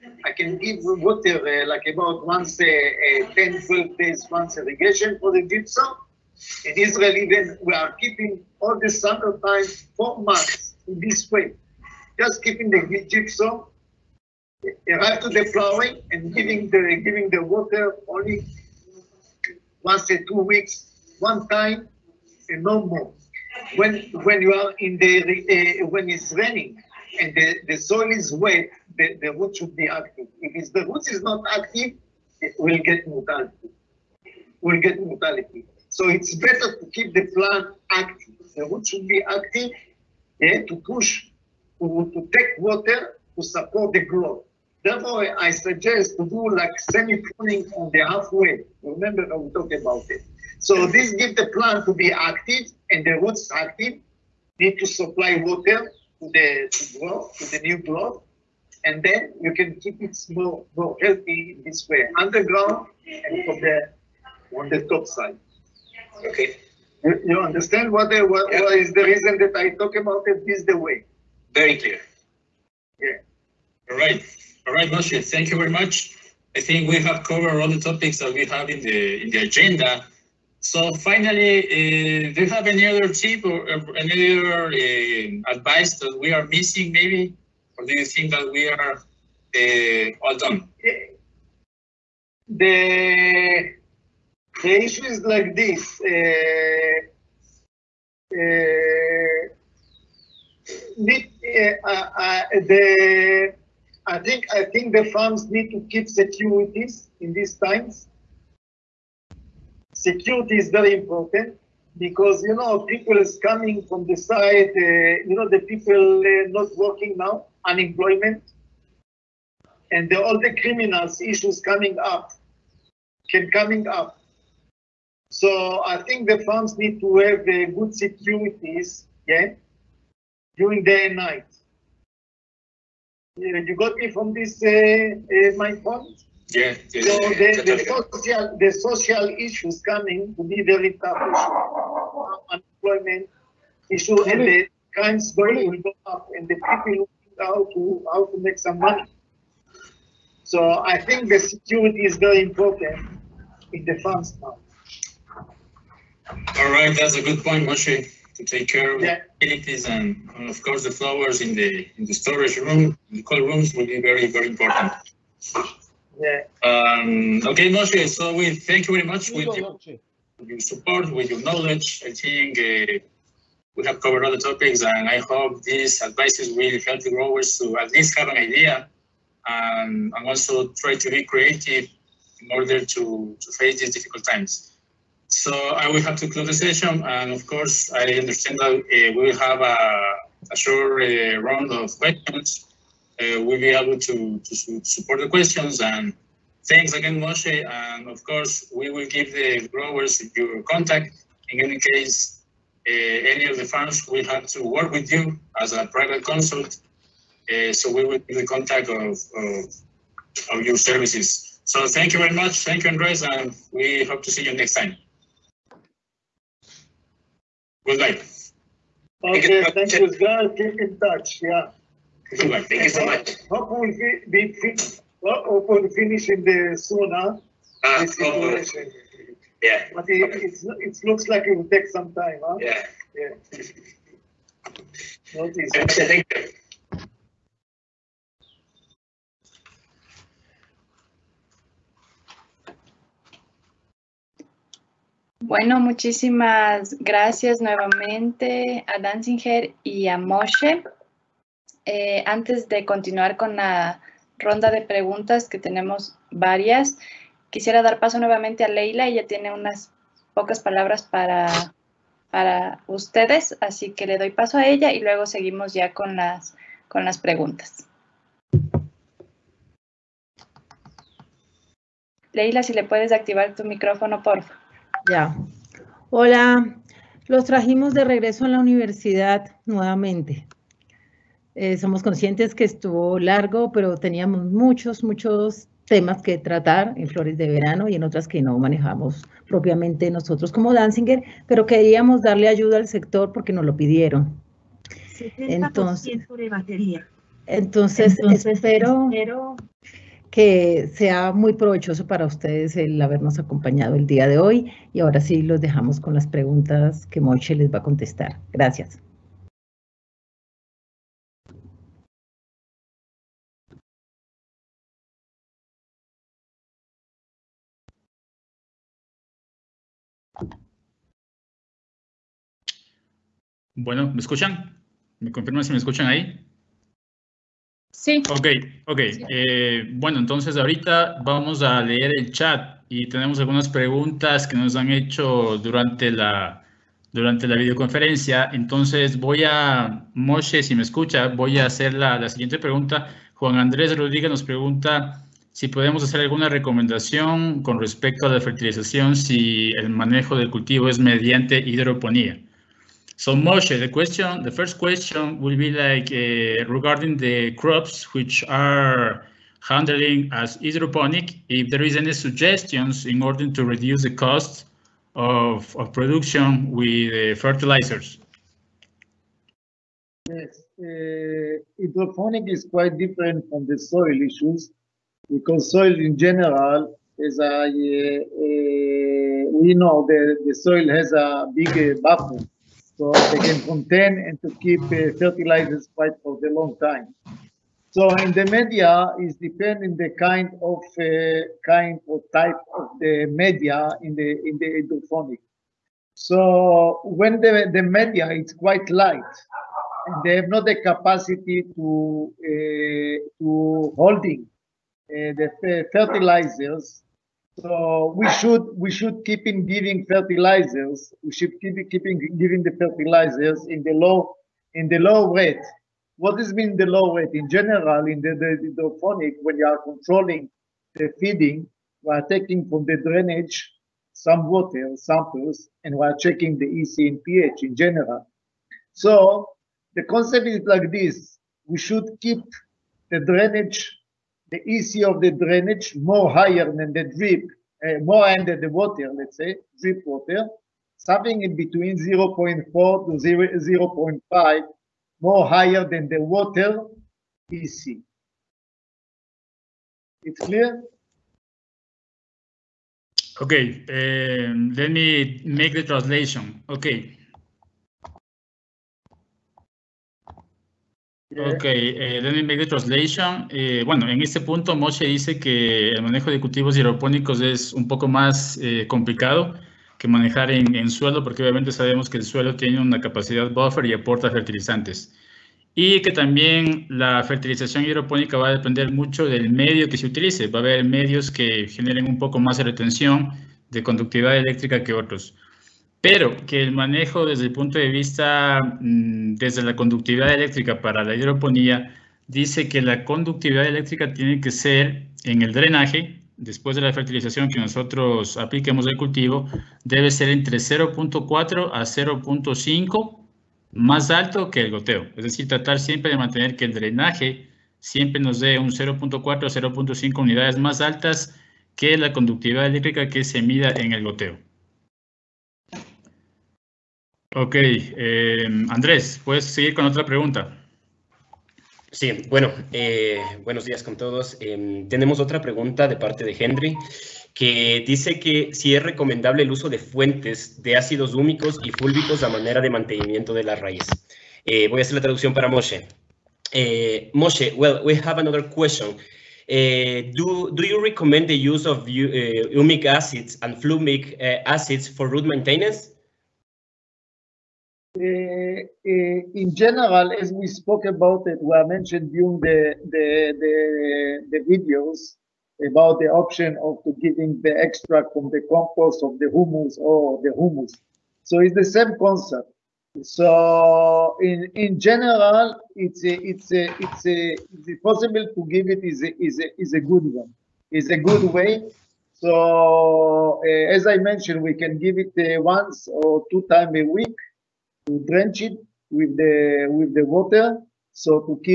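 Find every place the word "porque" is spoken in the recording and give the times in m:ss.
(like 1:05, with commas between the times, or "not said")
4:53, 7:51.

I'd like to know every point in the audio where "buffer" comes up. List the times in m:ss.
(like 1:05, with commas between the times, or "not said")
6:22, 7:53.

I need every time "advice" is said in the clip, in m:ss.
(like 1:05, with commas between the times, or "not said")
1:25, 2:56.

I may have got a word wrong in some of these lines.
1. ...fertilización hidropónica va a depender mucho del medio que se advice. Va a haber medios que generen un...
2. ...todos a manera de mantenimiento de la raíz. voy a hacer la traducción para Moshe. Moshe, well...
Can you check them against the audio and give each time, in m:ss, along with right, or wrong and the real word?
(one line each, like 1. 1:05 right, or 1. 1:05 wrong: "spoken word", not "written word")
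1. 7:57 wrong: "utilice", not "advice"
2. 8:51 wrong: "fúlbicos", not "todos".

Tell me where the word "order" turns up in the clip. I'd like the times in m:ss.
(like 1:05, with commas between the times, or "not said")
3:02, 6:03.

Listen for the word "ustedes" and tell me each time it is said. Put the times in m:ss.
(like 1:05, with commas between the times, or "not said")
4:22, 5:02.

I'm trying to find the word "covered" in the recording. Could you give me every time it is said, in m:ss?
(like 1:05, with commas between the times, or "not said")
1:17, 2:53.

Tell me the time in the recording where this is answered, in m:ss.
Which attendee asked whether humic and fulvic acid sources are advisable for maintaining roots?
8:46.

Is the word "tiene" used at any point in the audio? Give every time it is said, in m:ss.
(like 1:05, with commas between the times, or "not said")
4:19, 7:52, 8:14.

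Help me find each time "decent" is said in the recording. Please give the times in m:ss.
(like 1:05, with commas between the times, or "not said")
not said.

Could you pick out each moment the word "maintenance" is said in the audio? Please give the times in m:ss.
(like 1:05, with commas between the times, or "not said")
9:05.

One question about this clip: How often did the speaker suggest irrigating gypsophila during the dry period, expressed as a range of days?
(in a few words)
10 to 12 days.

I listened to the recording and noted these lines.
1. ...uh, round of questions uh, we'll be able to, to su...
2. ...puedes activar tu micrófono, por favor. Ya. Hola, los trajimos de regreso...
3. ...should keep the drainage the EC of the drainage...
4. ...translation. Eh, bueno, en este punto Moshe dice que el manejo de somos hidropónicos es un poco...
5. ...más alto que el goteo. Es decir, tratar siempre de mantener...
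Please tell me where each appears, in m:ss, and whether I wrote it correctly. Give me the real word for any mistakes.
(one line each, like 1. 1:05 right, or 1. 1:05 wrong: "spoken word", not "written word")
1. 3:11 right
2. 4:32 right
3. 7:11 right
4. 7:42 wrong: "cultivos", not "somos"
5. 8:23 right.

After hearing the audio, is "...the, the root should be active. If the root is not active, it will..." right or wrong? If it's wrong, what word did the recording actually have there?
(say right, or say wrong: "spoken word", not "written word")
right.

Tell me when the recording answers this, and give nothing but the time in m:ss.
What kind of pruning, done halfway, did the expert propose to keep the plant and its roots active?
0:46.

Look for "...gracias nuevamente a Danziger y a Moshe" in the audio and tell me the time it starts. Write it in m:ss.
4:06.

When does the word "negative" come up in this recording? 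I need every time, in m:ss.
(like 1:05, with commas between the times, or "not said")
not said.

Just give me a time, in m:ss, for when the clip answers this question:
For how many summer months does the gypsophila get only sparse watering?
0:09.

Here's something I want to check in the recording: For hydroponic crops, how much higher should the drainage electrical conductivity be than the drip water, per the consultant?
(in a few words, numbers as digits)
0.4 to 0.5.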